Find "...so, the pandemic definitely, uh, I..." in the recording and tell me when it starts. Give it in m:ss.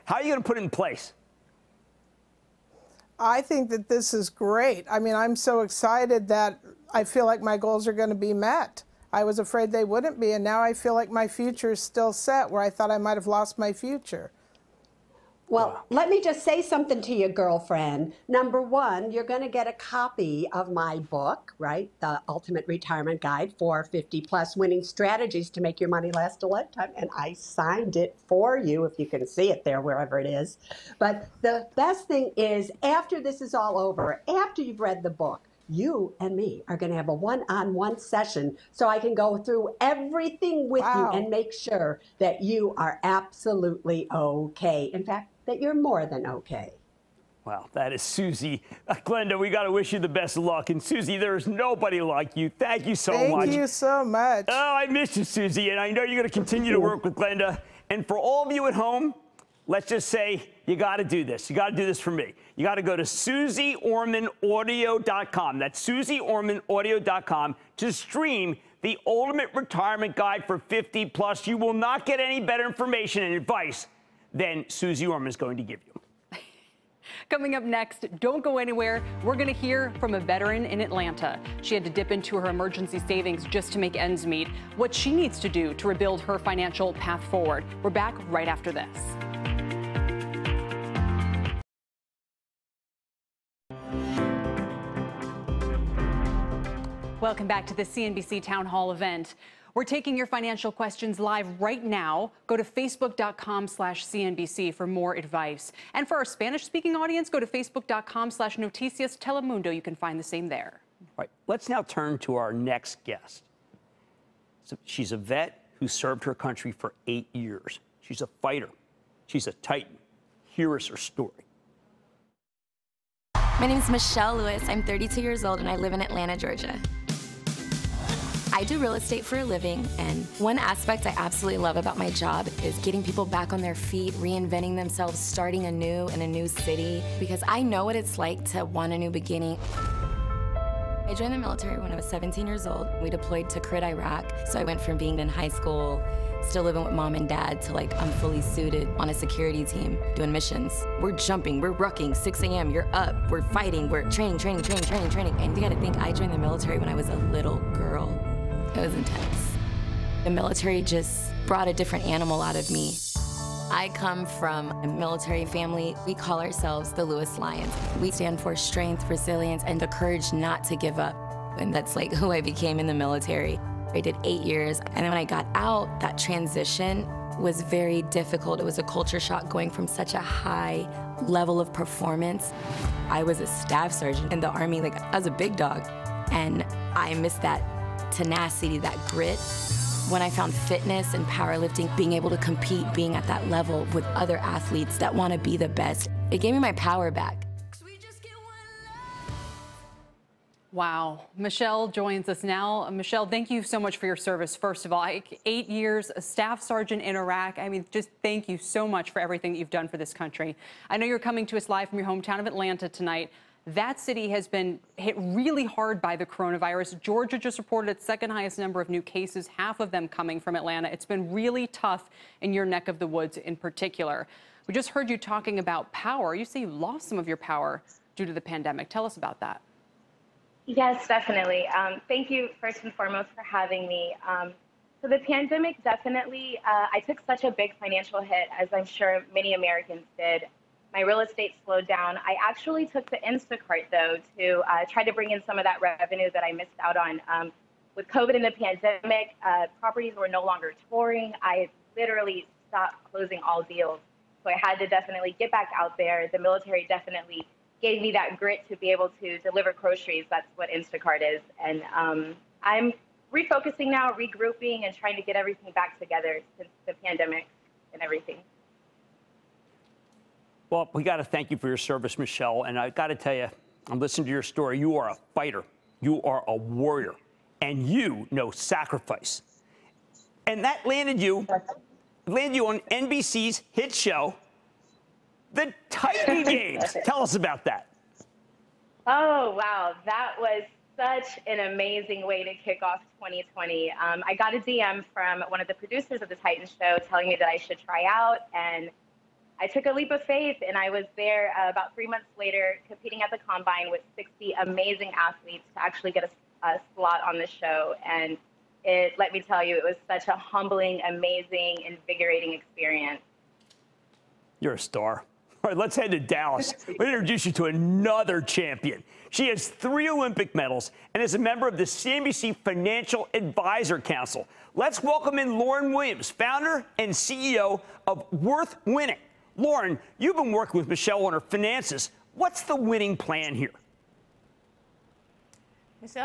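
3:55.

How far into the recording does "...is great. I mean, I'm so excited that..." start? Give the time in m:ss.
0:04.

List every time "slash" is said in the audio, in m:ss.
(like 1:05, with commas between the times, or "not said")
1:43, 1:48.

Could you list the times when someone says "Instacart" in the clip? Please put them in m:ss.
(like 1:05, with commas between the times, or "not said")
4:03, 4:20.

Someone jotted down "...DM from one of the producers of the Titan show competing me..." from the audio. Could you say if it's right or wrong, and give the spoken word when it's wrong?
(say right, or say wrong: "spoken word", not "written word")
wrong: "telling", not "competing".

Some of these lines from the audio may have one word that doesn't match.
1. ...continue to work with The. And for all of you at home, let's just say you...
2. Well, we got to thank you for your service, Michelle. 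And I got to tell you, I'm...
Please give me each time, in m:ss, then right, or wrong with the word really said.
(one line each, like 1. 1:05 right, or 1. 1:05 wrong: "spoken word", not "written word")
1. 0:56 wrong: "Glenda", not "The"
2. 4:30 right.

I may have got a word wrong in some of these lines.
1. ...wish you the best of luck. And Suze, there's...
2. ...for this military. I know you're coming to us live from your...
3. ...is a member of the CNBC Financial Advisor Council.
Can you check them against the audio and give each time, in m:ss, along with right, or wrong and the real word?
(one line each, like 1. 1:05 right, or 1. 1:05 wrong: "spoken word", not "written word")
1. 0:49 right
2. 3:29 wrong: "country", not "military"
3. 5:21 right.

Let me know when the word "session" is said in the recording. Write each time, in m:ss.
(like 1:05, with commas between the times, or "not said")
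0:37.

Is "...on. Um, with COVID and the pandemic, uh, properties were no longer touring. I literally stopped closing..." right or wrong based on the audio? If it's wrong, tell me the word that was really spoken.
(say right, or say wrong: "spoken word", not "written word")
right.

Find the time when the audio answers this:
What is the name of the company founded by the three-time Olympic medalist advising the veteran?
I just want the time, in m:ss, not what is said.
5:28.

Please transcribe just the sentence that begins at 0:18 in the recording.
Number one, you're going to get a copy of my book, right?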